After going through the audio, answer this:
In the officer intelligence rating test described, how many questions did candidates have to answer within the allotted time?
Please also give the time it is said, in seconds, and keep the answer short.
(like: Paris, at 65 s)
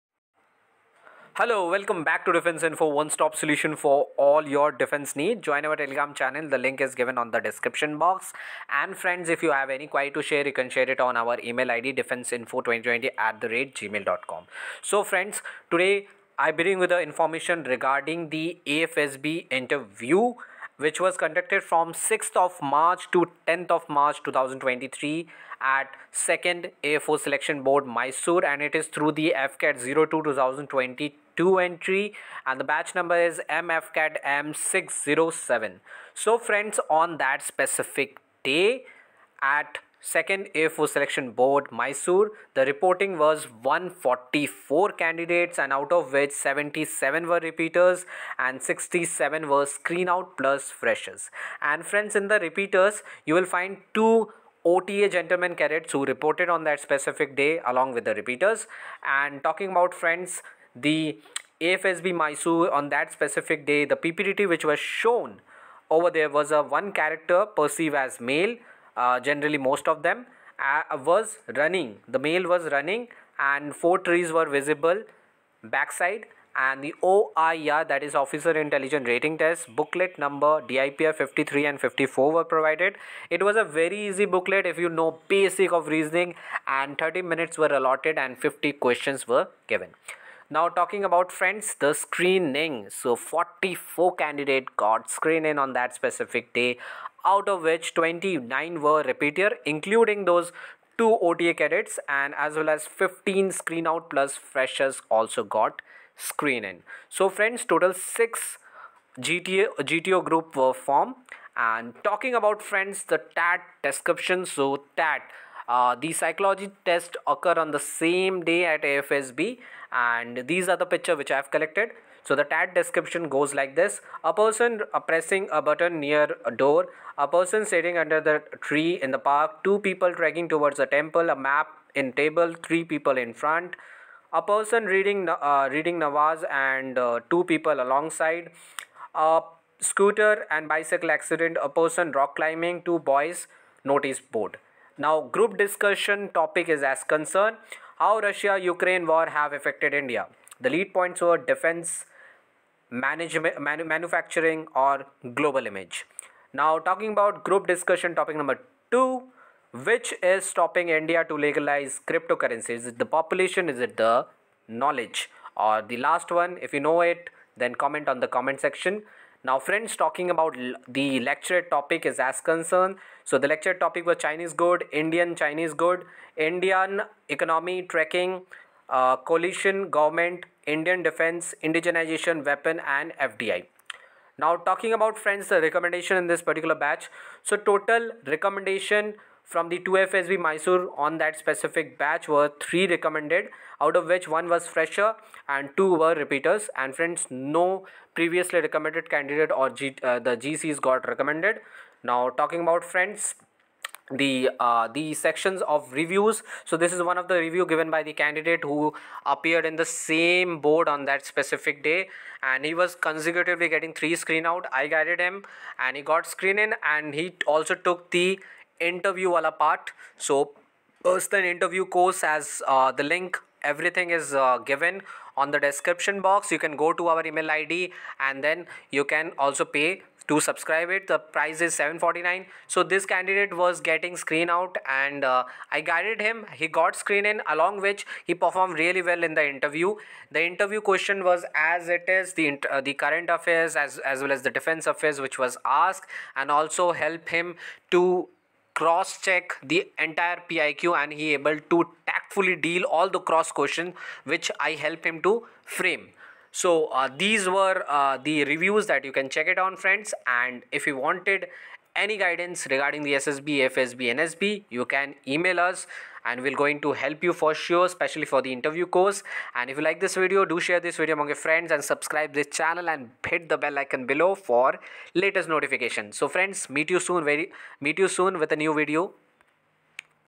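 50, at 88 s.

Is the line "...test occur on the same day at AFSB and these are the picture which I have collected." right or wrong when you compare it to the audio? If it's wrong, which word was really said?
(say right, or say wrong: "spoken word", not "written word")
right.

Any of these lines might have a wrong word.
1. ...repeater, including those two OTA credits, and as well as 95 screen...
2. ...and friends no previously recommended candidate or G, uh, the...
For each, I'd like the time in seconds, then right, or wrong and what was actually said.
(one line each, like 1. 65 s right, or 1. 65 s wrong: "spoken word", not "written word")
1. 99 s wrong: "15", not "95"
2. 196 s right.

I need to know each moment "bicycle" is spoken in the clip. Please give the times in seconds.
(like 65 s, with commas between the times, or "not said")
140 s.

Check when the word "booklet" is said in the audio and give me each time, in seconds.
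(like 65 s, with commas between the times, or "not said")
79 s, 84 s.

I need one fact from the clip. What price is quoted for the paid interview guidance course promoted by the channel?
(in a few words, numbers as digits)
749.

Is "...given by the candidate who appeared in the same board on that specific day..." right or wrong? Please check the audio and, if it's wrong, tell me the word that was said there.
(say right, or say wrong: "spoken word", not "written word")
right.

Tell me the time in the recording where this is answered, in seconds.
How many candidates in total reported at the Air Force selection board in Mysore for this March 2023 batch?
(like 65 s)
43 s.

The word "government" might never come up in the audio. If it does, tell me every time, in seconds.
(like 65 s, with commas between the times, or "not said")
179 s.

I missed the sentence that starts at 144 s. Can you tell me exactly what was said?
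Now group discussion topic is as concerned how Russia Ukraine war have affected India.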